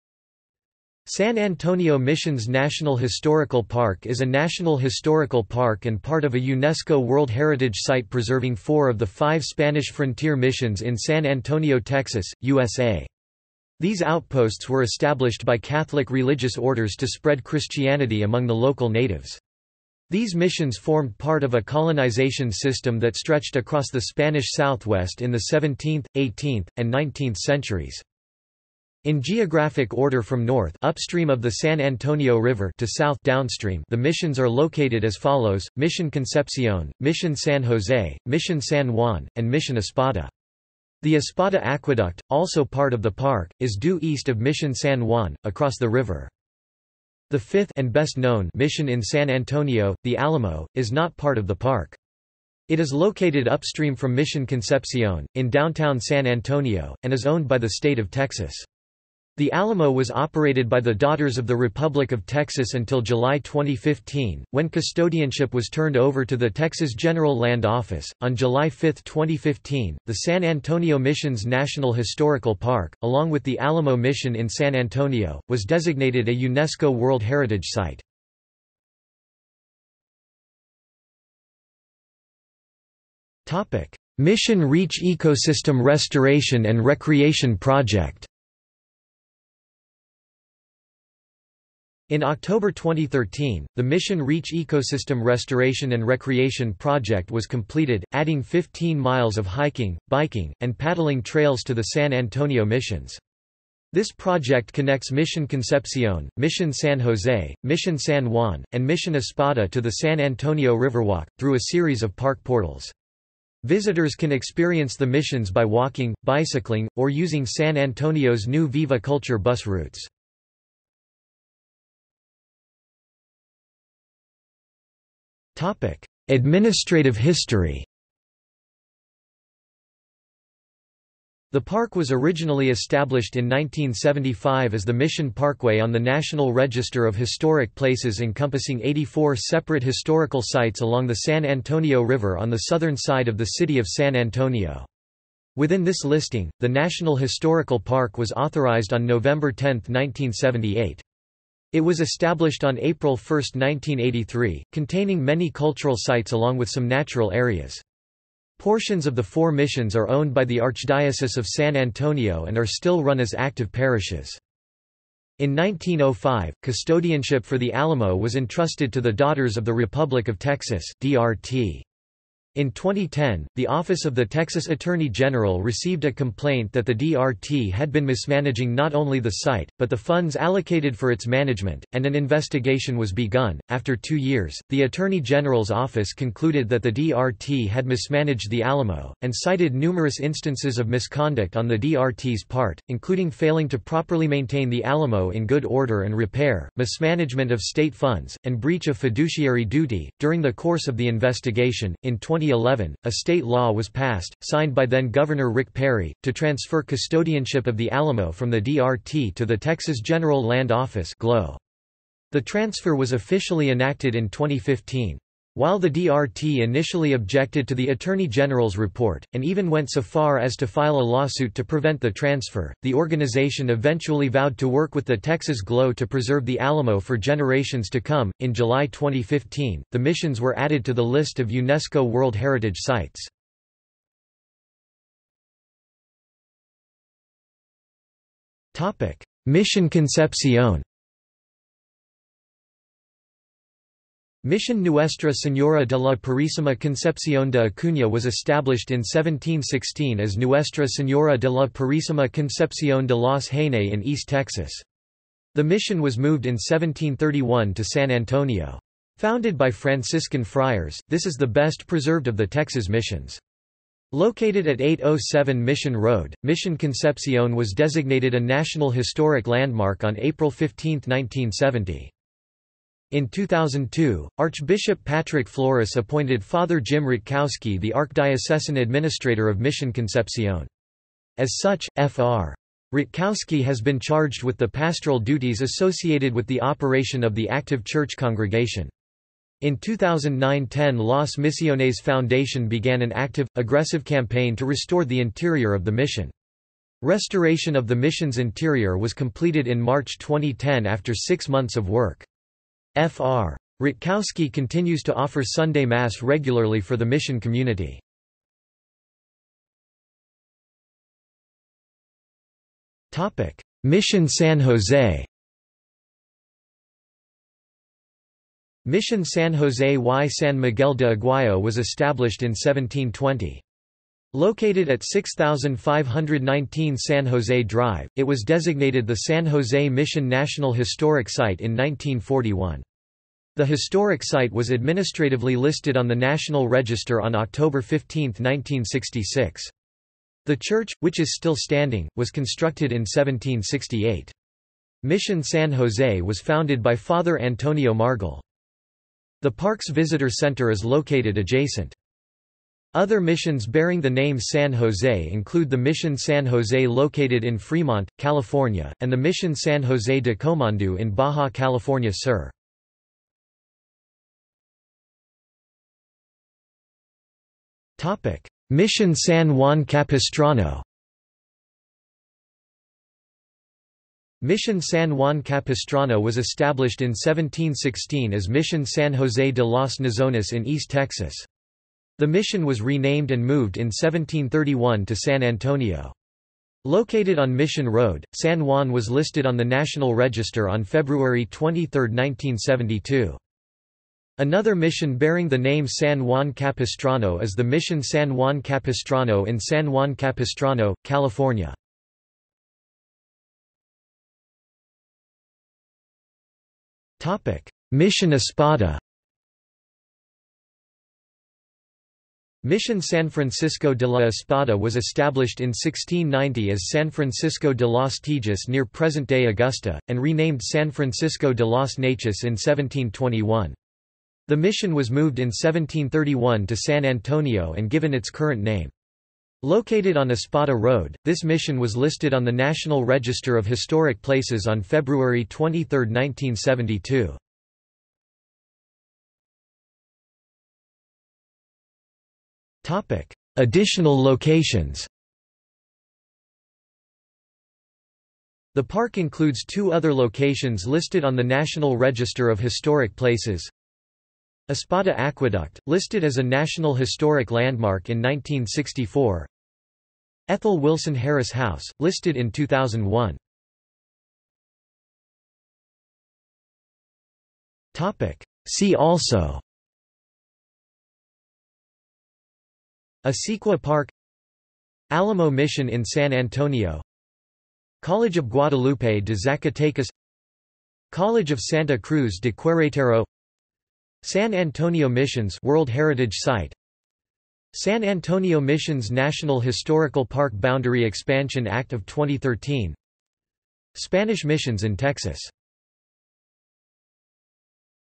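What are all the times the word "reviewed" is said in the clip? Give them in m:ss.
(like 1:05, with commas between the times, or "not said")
not said.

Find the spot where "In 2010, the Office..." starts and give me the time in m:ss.
2:52.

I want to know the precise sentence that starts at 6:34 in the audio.
Another mission bearing the name San Juan Capistrano is the Mission San Juan Capistrano in San Juan Capistrano, California.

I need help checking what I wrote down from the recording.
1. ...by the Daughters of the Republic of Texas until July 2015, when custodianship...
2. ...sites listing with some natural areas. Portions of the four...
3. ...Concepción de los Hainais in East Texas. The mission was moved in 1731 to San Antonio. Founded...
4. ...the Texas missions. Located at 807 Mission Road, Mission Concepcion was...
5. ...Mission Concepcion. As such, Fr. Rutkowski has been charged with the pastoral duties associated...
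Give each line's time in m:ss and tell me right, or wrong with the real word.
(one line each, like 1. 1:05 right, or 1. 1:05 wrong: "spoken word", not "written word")
1. 1:00 right
2. 2:35 wrong: "along", not "listing"
3. 4:12 right
4. 4:22 right
5. 4:39 right.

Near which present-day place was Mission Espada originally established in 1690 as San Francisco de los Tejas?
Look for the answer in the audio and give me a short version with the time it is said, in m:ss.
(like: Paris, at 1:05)
Augusta, at 6:59.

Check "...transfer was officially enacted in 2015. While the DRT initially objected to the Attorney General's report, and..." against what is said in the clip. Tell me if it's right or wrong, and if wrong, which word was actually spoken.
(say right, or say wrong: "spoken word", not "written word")
right.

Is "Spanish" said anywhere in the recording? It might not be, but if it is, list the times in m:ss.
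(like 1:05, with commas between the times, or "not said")
0:09, 0:23, 8:13.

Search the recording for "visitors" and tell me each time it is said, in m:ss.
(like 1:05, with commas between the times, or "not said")
1:53, 5:49.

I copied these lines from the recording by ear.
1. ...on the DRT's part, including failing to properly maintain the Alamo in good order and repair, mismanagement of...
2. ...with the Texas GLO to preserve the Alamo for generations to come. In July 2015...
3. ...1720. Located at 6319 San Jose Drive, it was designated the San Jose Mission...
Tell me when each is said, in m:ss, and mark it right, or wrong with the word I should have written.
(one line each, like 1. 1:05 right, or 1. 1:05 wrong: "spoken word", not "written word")
1. 3:11 right
2. 3:44 right
3. 5:22 wrong: "6519", not "6319".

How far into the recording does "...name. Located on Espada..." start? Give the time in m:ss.
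7:08.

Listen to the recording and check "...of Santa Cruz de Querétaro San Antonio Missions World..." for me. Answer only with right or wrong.
right.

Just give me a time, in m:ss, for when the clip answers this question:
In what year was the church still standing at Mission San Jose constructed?
5:43.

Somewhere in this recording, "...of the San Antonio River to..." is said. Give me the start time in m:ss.
0:31.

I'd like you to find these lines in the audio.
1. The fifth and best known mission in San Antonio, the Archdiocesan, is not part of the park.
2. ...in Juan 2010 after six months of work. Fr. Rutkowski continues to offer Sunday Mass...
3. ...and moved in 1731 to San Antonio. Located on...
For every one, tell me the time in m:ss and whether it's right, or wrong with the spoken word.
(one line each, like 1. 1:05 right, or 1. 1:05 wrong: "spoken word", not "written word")
1. 0:47 wrong: "Alamo", not "Archdiocesan"
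2. 4:59 wrong: "March", not "Juan"
3. 6:23 right.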